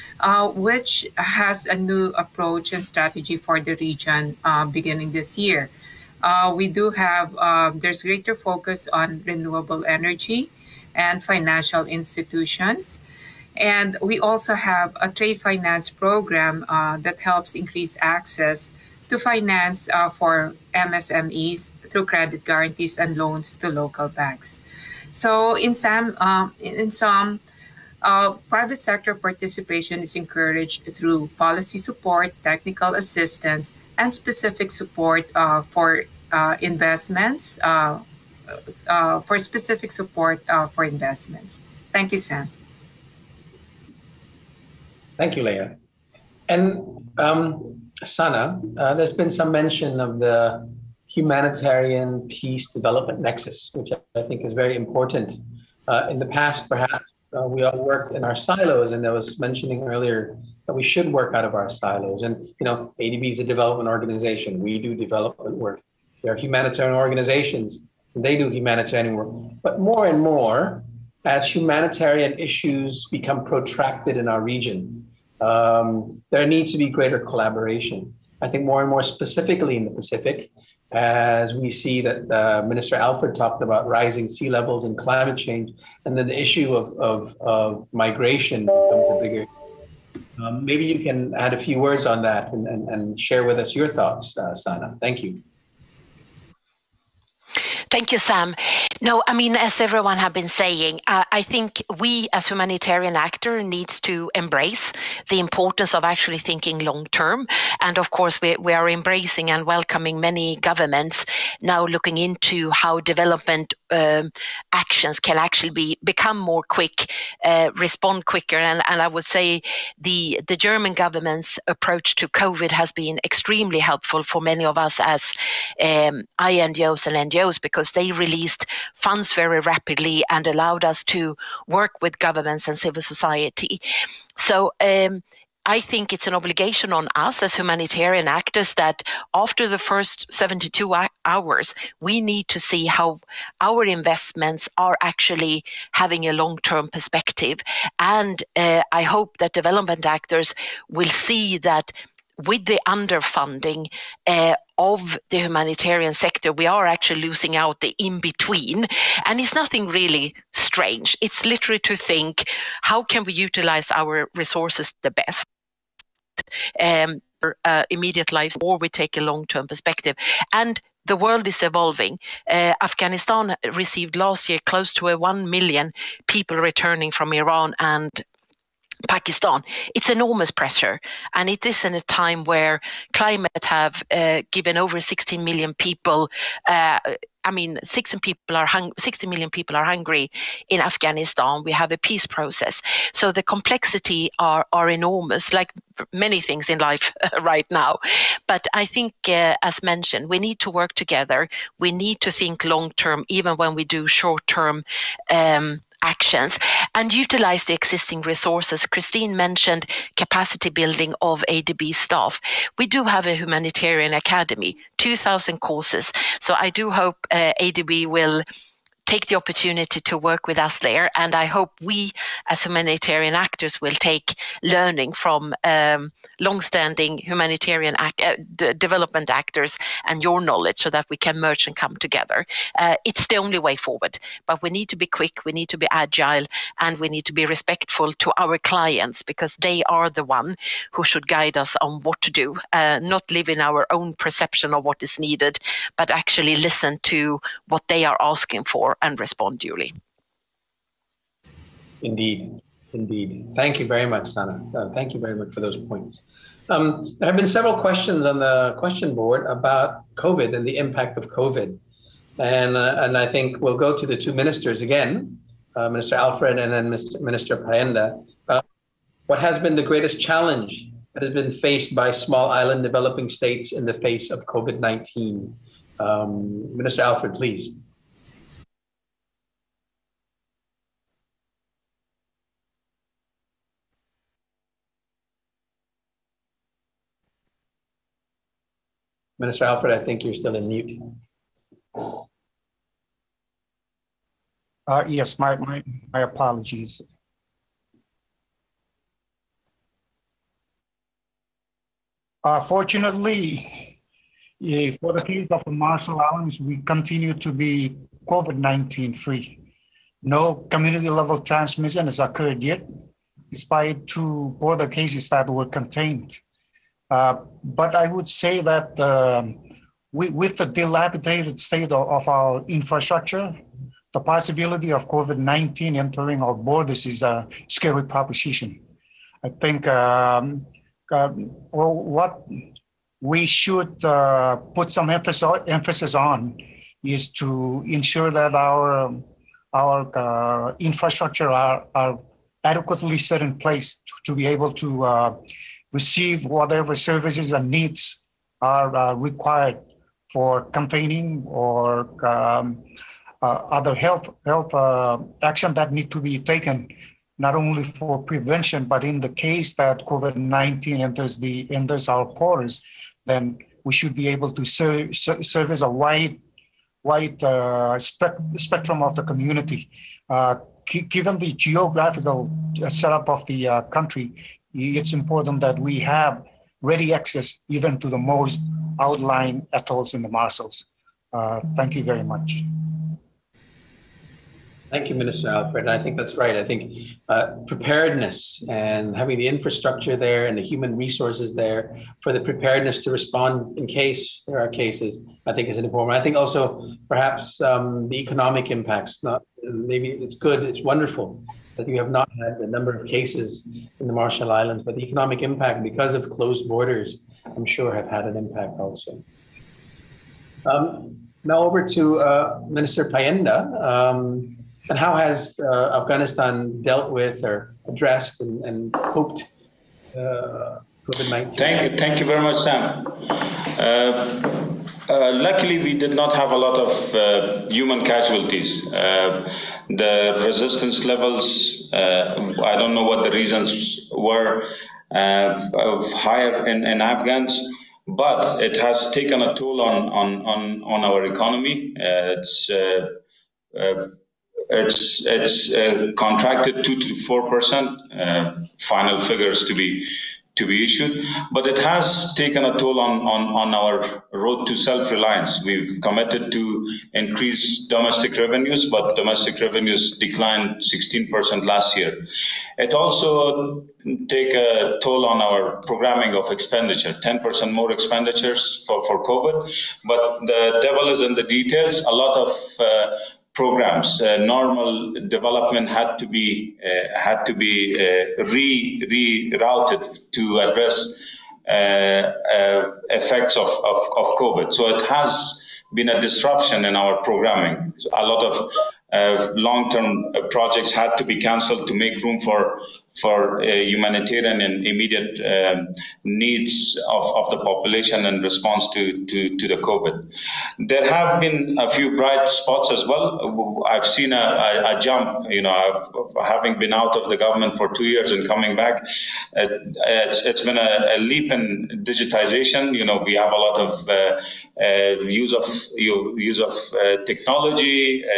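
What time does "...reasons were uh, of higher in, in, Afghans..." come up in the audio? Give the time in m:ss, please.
7:13.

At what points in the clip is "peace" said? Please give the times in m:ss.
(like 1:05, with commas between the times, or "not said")
0:52, 3:11.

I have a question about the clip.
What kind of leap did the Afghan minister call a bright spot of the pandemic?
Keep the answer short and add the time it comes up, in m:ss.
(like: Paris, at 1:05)
Digitization, at 8:32.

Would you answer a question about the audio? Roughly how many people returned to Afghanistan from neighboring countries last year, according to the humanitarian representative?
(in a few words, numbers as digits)
1 million.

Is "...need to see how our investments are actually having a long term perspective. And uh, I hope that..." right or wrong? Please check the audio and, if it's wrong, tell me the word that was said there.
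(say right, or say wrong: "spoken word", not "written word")
right.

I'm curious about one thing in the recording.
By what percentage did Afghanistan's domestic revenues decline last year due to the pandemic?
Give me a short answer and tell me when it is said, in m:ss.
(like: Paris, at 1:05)
16%, at 7:40.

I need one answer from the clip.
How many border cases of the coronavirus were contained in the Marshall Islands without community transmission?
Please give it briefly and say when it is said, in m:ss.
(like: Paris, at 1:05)
2, at 5:14.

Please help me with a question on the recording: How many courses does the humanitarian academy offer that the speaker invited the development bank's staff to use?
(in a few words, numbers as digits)
2,000.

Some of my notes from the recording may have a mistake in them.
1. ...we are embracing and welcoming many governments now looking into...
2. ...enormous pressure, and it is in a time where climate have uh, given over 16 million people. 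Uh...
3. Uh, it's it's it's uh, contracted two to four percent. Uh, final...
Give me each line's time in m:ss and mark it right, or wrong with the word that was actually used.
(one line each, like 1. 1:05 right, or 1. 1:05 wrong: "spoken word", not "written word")
1. 1:48 right
2. 3:00 right
3. 7:21 right.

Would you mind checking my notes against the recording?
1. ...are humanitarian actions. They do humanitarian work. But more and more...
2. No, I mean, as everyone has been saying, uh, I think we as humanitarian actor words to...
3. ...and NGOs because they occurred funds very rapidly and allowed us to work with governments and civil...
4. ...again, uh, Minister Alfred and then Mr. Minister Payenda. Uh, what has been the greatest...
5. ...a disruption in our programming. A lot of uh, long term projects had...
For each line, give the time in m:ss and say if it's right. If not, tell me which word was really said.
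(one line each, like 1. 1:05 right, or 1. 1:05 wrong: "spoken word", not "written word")
1. 1:06 wrong: "organizations", not "actions"
2. 1:39 wrong: "needs", not "words"
3. 2:07 wrong: "released", not "occurred"
4. 4:24 right
5. 8:06 right.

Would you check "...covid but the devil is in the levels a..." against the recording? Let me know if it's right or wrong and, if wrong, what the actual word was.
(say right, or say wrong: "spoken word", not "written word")
wrong: "details", not "levels".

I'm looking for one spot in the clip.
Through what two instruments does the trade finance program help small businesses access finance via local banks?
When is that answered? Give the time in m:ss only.
0:22.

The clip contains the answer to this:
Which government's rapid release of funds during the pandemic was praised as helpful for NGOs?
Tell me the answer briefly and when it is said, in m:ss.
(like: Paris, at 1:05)
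German, at 2:00.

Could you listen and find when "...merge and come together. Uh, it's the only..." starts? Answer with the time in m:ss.
3:51.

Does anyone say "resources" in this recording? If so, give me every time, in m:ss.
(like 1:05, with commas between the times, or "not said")
2:44, 3:28, 6:30.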